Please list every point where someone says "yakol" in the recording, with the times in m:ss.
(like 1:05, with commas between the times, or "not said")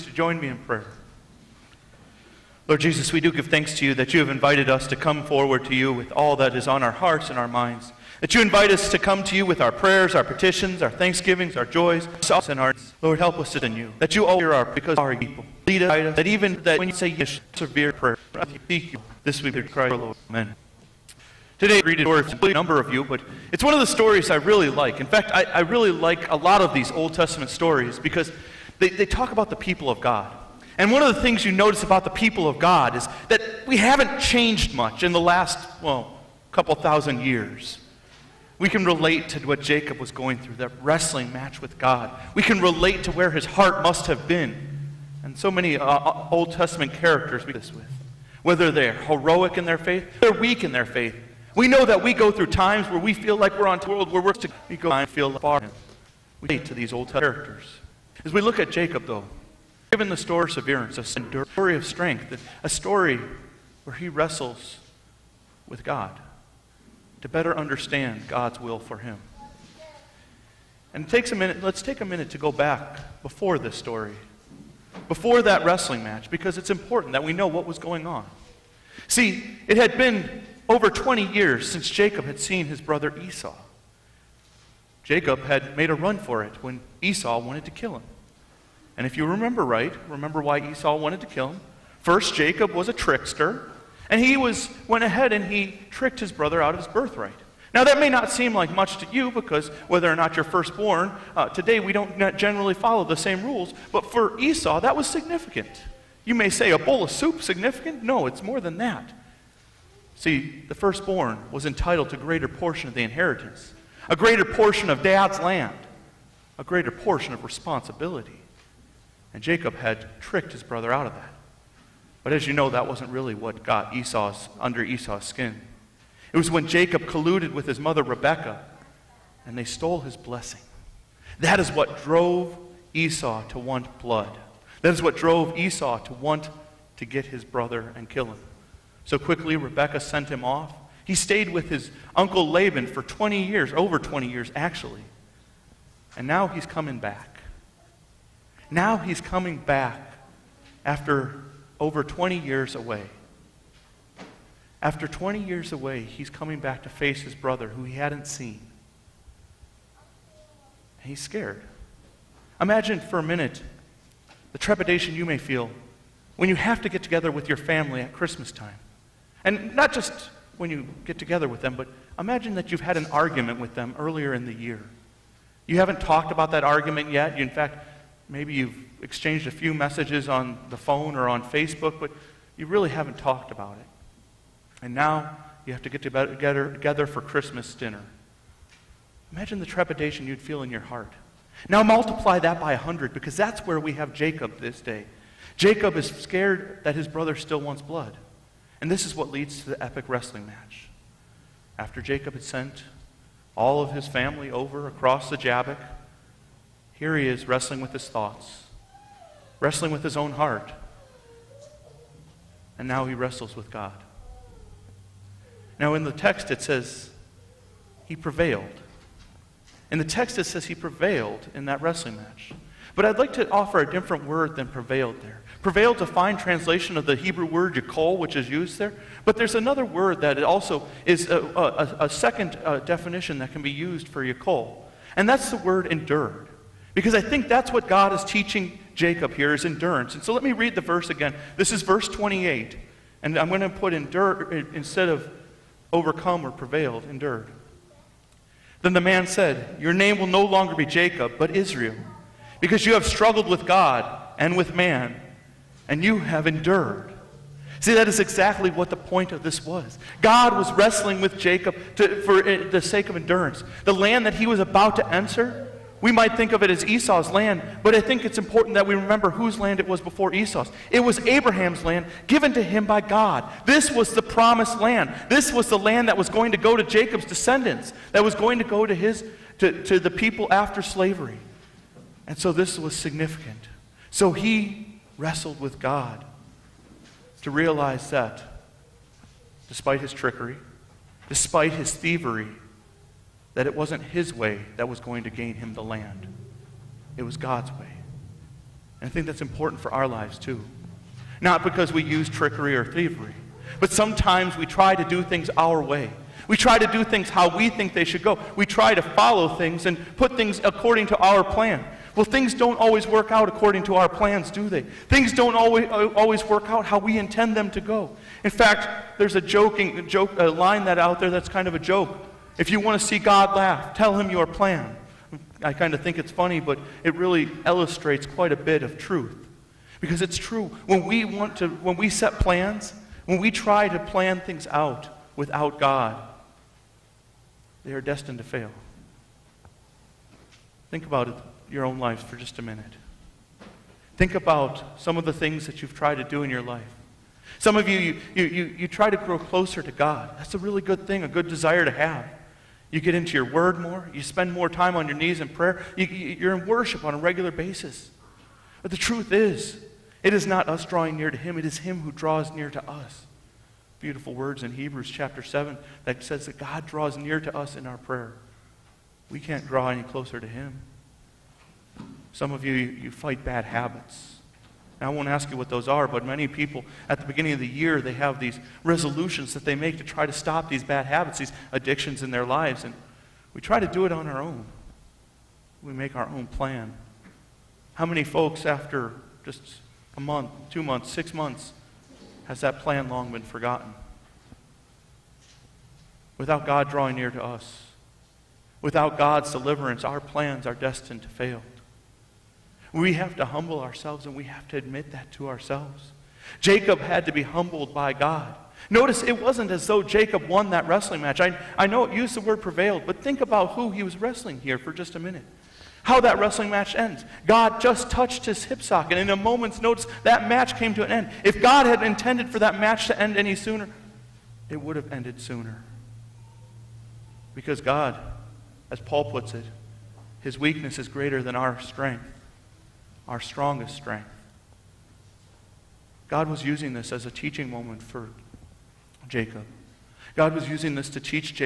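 3:47, 3:54.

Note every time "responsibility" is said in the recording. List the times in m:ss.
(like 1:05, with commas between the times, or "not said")
1:57.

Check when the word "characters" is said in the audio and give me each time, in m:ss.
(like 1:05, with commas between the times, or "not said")
0:46, 0:57.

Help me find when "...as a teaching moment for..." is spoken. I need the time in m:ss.
7:17.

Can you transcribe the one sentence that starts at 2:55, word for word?
You haven't talked about that argument yet.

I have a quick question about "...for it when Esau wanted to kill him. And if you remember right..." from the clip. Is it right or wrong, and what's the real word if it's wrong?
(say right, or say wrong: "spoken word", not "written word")
right.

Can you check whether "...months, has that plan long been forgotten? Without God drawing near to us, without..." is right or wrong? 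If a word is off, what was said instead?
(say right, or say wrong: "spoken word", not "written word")
right.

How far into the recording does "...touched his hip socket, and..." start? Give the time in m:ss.
6:58.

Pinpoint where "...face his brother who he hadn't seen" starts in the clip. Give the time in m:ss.
2:36.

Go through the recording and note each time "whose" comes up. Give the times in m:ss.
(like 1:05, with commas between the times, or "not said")
4:29.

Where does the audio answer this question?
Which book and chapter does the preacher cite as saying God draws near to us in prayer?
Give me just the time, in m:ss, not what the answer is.
6:04.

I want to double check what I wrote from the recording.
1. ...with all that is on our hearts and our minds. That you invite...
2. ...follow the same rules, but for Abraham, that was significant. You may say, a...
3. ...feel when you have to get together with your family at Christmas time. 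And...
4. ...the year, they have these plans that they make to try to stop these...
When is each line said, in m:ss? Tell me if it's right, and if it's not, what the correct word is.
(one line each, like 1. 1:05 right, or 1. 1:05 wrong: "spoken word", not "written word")
1. 0:05 right
2. 1:42 wrong: "Esau", not "Abraham"
3. 2:45 right
4. 6:17 wrong: "resolutions", not "plans".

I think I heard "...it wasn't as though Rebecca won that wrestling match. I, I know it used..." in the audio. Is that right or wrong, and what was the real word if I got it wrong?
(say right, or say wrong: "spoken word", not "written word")
wrong: "Jacob", not "Rebecca".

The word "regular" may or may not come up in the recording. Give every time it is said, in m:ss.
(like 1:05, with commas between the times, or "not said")
5:57.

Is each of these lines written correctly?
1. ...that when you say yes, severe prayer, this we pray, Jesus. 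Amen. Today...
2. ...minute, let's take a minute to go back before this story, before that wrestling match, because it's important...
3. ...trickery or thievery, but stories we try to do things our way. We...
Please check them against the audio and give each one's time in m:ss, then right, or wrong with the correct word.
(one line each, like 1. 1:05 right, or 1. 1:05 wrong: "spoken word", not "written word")
1. 0:16 wrong: "Lord", not "Jesus"
2. 1:11 right
3. 5:02 wrong: "sometimes", not "stories".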